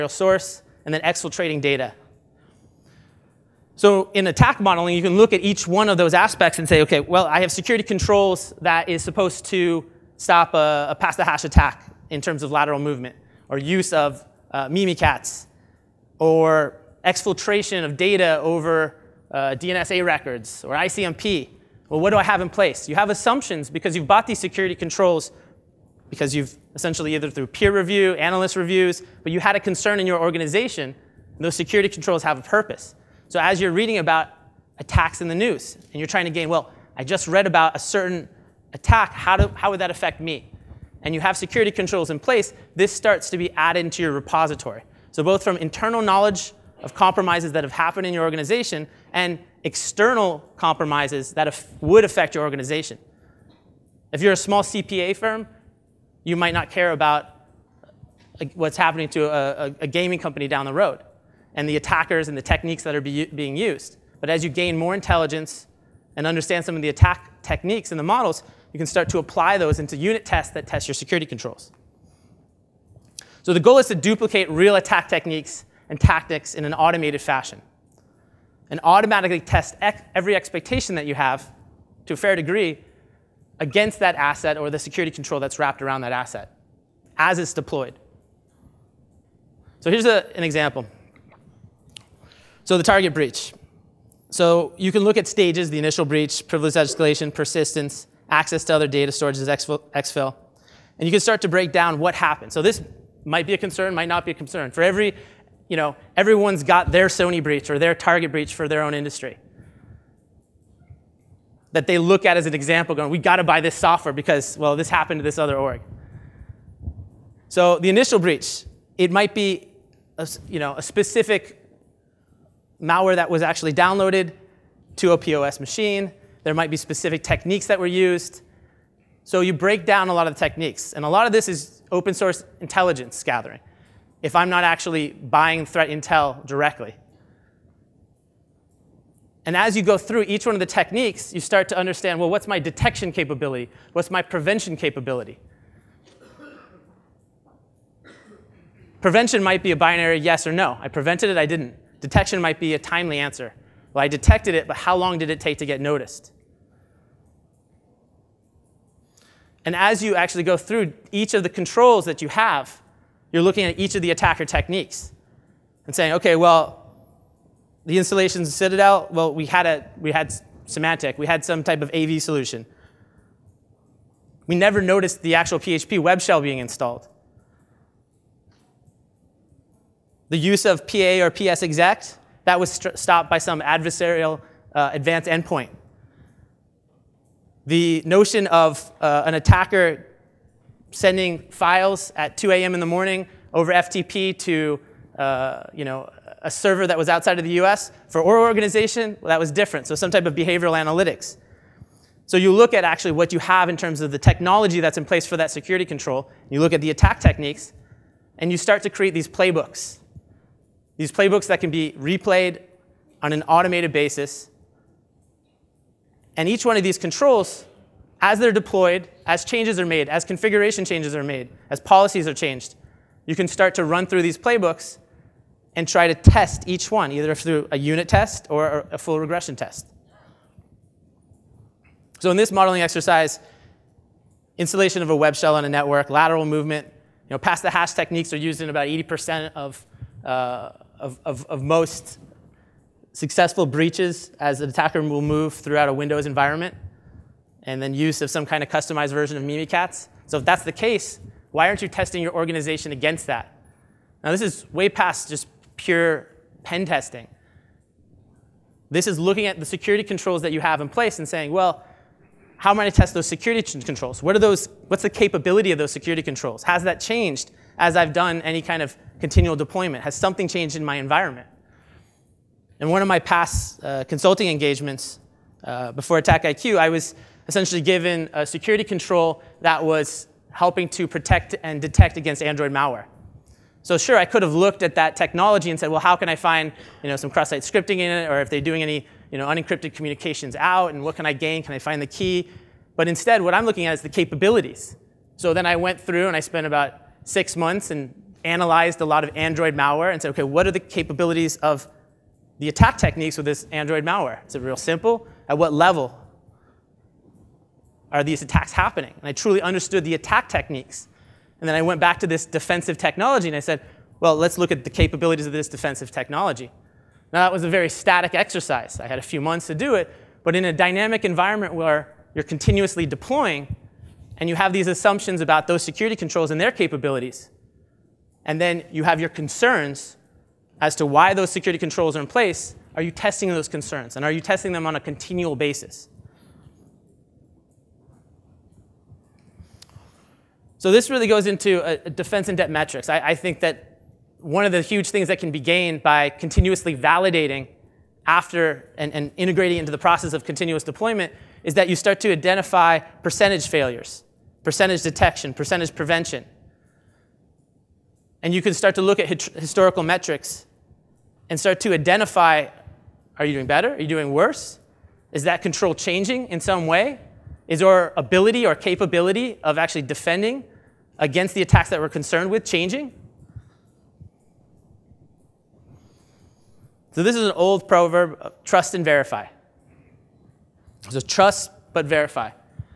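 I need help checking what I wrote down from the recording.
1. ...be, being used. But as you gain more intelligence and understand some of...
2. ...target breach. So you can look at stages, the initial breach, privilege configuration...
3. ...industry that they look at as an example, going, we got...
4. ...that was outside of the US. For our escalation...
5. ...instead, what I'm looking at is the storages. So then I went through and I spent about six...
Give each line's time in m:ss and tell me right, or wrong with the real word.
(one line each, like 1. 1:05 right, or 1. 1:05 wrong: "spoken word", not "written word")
1. 1:03 right
2. 1:32 wrong: "escalation", not "configuration"
3. 1:48 right
4. 3:16 wrong: "organization", not "escalation"
5. 4:53 wrong: "capabilities", not "storages".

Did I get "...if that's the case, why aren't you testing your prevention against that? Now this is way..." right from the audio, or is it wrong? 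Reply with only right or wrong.
wrong.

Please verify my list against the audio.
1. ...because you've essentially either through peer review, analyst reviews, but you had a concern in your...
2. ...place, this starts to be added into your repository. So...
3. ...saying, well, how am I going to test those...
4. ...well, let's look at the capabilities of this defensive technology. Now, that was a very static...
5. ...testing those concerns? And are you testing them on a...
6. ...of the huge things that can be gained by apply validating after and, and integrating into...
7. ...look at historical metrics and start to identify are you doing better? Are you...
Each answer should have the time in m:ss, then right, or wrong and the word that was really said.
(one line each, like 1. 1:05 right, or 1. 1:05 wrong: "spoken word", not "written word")
1. 0:26 right
2. 0:42 right
3. 4:21 right
4. 5:14 right
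5. 5:33 right
6. 5:44 wrong: "continuously", not "apply"
7. 5:59 right.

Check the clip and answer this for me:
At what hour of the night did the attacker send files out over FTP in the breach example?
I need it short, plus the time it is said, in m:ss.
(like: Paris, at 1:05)
2 a.m., at 3:12.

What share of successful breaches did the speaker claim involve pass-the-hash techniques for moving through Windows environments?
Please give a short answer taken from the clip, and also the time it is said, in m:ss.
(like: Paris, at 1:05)
80%, at 3:58.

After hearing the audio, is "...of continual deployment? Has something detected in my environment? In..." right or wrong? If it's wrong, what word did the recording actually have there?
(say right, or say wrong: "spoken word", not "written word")
wrong: "changed", not "detected".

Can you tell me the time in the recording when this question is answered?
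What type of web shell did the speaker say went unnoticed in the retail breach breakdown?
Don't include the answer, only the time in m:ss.
2:55.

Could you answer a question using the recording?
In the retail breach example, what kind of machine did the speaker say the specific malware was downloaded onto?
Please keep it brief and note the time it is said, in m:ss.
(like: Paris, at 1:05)
POS machine, at 2:05.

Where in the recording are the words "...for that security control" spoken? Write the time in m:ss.
3:25.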